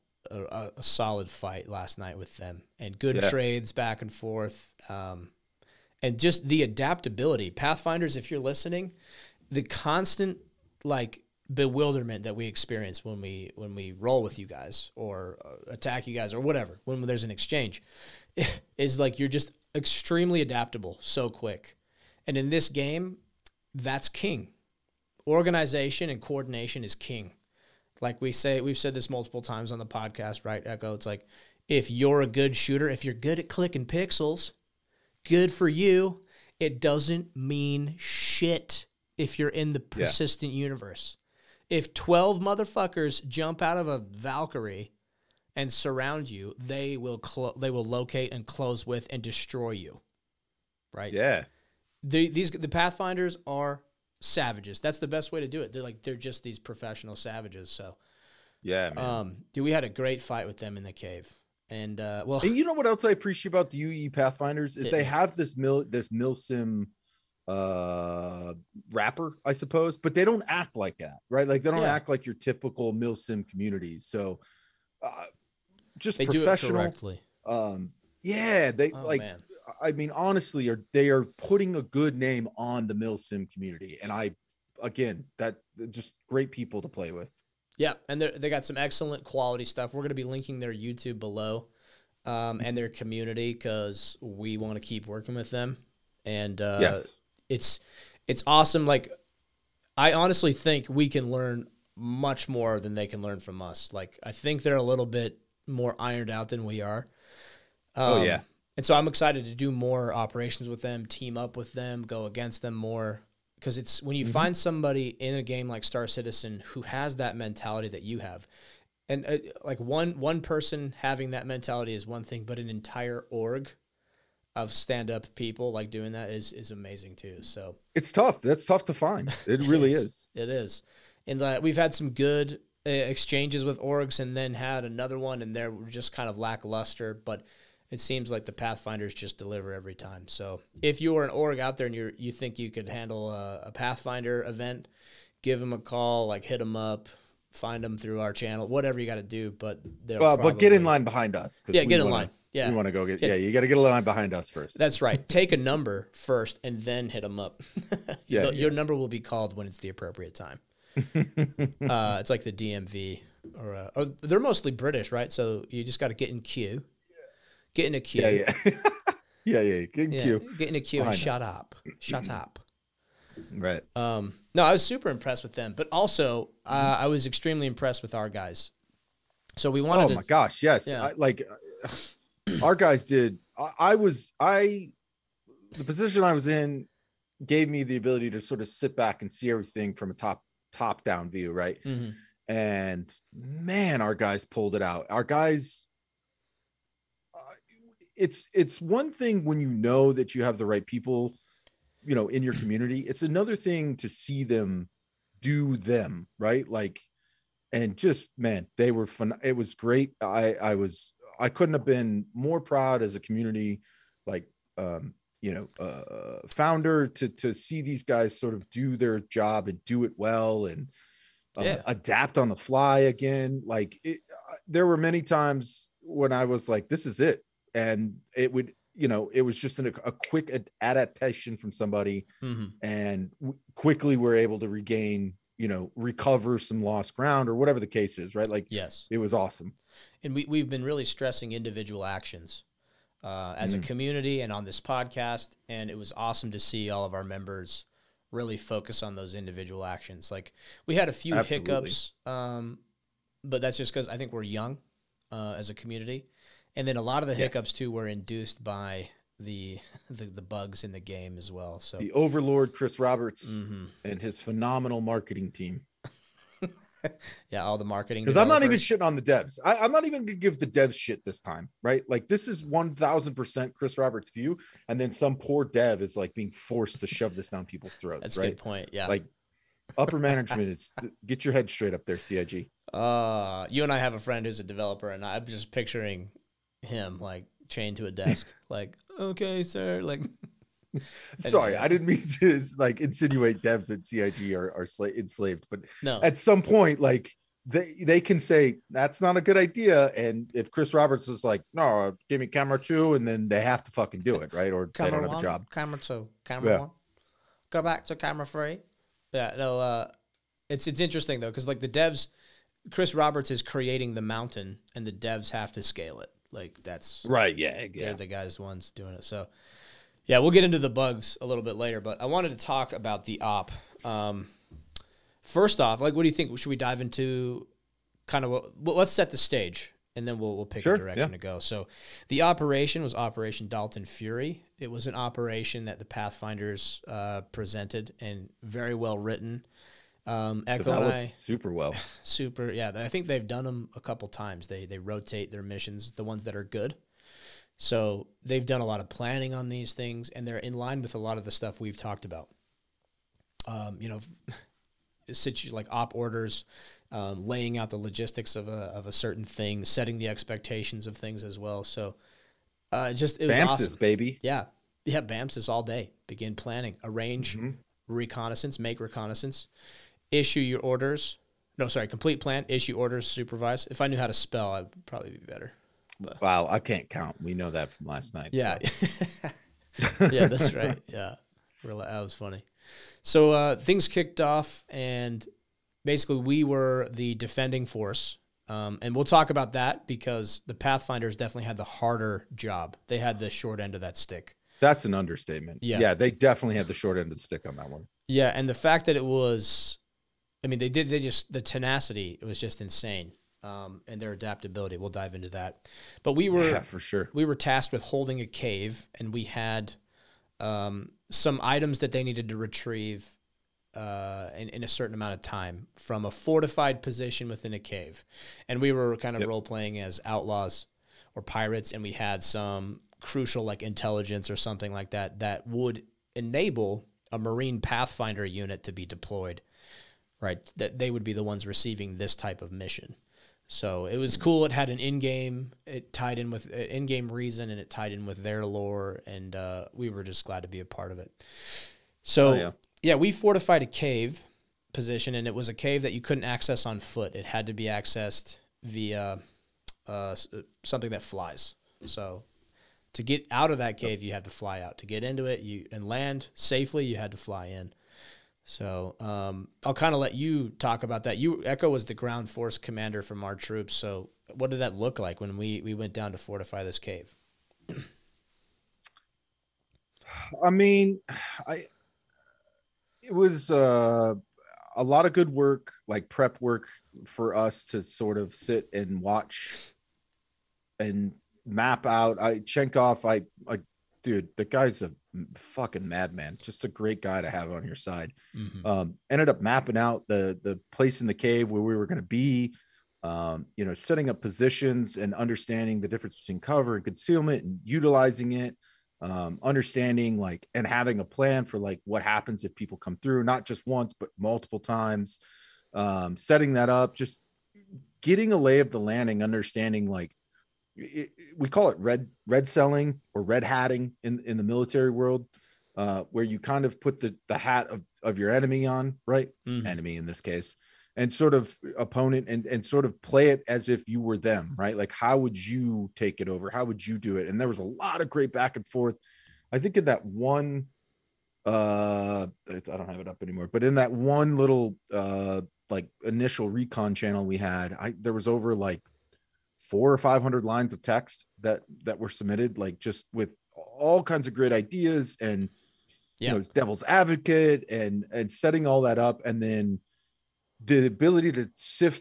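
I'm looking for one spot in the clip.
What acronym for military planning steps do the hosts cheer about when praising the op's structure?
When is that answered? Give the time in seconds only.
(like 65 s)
363 s.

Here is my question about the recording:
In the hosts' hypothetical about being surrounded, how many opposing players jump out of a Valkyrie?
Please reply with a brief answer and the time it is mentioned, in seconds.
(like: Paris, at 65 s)
12, at 41 s.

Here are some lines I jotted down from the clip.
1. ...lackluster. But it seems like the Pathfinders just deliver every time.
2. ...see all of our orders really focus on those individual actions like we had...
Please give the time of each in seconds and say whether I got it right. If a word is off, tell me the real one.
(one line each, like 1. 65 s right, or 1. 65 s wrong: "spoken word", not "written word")
1. 136 s right
2. 246 s wrong: "members", not "orders".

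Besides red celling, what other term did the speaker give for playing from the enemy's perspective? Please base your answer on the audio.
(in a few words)
Red hatting.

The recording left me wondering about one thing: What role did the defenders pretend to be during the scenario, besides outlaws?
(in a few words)
Pirates.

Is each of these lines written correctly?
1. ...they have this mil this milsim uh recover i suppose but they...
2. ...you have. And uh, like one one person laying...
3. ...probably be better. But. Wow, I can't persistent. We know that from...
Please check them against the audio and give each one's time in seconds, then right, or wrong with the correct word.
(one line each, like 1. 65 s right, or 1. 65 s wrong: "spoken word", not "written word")
1. 64 s wrong: "wrapper", not "recover"
2. 118 s wrong: "having", not "laying"
3. 375 s wrong: "count", not "persistent".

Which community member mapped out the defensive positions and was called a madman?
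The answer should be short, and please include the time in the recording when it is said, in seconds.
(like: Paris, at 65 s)
Chenkov, at 482 s.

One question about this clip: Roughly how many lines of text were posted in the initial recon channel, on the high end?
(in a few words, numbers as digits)
500.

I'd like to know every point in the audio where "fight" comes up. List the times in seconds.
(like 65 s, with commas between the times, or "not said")
1 s, 60 s.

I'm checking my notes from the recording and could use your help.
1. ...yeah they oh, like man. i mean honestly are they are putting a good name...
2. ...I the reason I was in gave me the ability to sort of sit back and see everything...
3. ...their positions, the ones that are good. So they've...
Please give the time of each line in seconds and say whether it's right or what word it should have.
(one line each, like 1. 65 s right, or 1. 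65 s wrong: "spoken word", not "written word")
1. 78 s right
2. 184 s wrong: "position", not "reason"
3. 345 s wrong: "missions", not "positions".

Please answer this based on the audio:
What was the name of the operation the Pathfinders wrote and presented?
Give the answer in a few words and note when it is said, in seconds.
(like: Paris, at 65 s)
Operation Dalton Fury, at 333 s.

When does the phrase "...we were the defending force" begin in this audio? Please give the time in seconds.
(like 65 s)
386 s.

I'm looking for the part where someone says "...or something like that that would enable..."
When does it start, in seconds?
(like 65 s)
424 s.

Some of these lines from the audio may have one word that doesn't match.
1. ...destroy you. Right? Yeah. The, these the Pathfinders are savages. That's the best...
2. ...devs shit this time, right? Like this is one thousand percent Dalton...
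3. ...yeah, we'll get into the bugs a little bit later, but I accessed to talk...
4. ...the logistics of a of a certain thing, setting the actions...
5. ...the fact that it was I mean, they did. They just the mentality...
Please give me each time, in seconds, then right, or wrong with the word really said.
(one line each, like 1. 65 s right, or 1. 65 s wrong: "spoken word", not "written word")
1. 49 s right
2. 270 s wrong: "Chris", not "Dalton"
3. 320 s wrong: "wanted", not "accessed"
4. 357 s wrong: "expectations", not "actions"
5. 398 s wrong: "tenacity", not "mentality".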